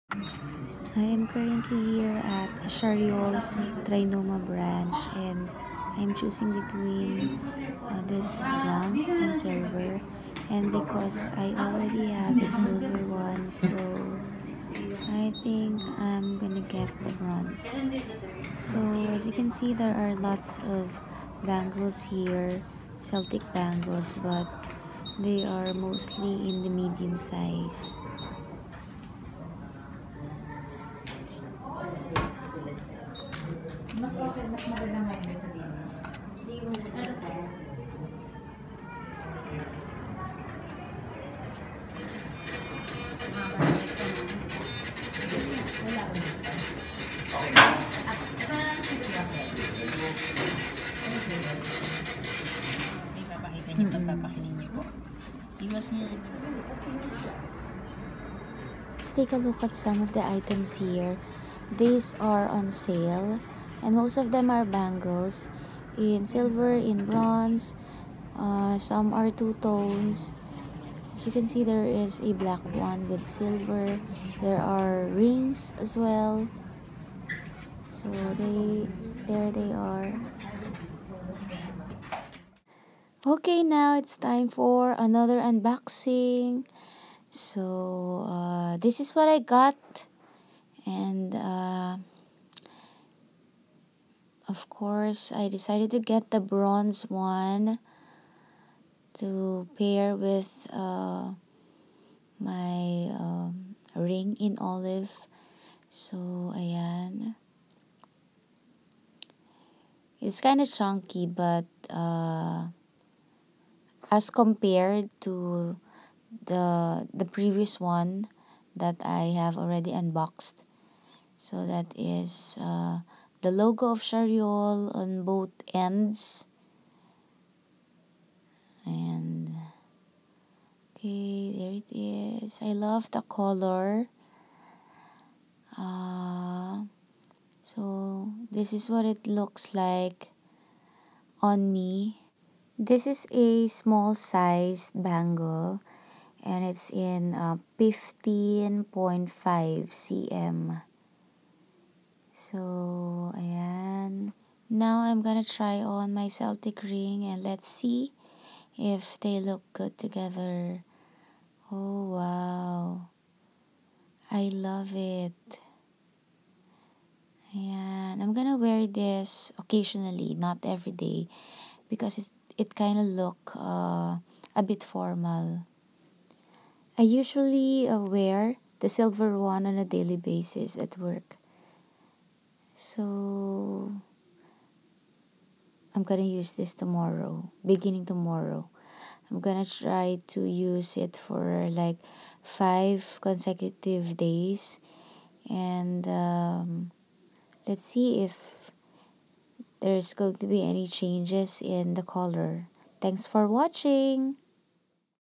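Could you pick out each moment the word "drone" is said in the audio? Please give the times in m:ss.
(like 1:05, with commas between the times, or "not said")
not said.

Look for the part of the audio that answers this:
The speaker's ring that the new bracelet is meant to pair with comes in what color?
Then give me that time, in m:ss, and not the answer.
1:44.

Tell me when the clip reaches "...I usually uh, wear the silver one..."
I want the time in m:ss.
2:56.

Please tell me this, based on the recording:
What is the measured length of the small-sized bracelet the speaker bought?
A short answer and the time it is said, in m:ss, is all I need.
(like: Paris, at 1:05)
15.5 cm, at 2:27.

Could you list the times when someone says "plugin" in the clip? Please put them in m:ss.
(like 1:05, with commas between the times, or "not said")
not said.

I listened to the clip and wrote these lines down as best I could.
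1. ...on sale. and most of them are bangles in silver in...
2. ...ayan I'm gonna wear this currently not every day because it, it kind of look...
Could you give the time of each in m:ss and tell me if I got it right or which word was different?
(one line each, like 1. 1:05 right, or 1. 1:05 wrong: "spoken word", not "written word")
1. 1:02 right
2. 2:47 wrong: "occasionally", not "currently".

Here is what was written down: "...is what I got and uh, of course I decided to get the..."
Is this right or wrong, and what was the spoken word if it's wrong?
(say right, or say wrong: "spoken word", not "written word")
right.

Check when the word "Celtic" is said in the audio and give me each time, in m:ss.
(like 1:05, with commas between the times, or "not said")
0:22, 2:36.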